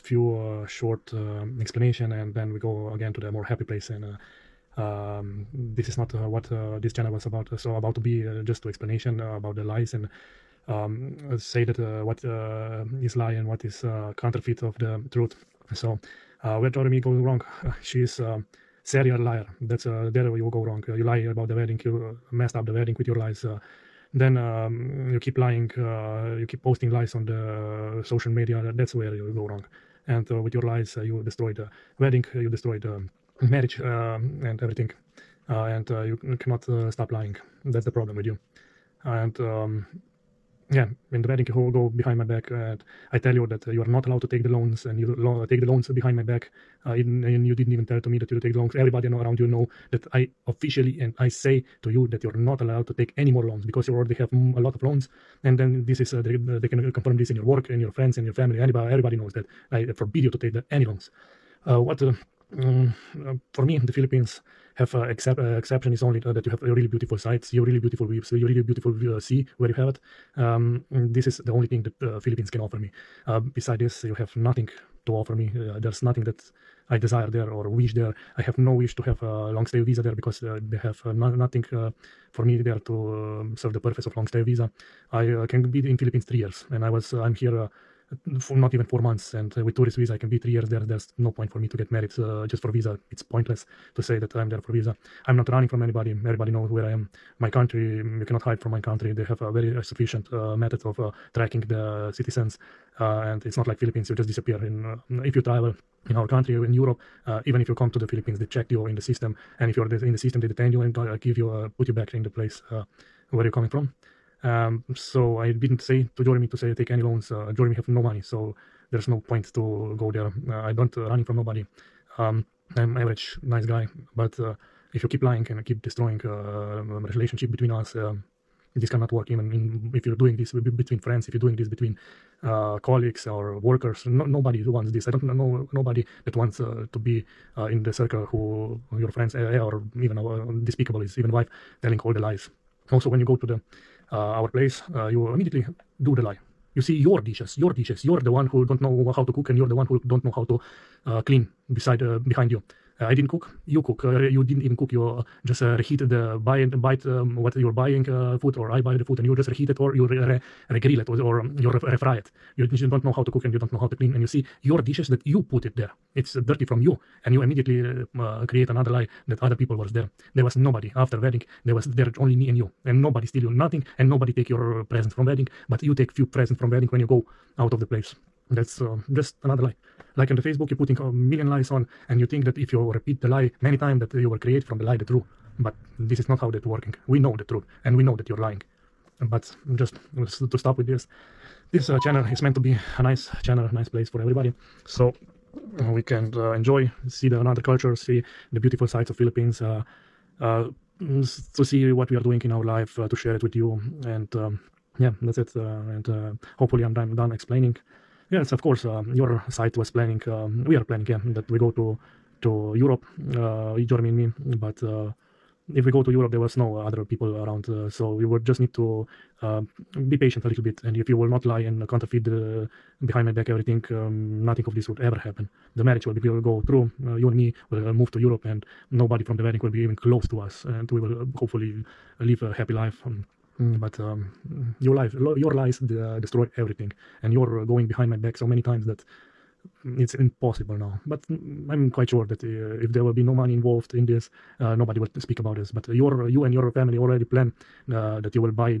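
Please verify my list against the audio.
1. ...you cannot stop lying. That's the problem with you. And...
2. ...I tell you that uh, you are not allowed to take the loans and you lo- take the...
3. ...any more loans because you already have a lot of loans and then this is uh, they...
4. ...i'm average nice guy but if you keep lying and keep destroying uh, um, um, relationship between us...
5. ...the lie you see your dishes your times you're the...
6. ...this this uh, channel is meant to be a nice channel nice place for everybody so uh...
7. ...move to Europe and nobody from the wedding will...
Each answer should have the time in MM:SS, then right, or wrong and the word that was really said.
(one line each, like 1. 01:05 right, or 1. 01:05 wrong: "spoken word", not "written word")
1. 00:36 right
2. 00:43 right
3. 00:53 right
4. 02:02 right
5. 02:26 wrong: "dishes", not "times"
6. 03:10 right
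7. 03:47 right.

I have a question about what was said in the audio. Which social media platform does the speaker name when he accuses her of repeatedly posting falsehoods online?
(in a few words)
Facebook.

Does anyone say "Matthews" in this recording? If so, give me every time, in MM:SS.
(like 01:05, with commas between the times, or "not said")
not said.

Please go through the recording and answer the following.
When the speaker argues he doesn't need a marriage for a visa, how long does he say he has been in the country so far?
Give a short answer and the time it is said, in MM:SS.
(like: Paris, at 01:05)
not even 4 months, at 01:28.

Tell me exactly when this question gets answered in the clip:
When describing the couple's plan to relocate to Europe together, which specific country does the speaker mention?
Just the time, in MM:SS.
03:33.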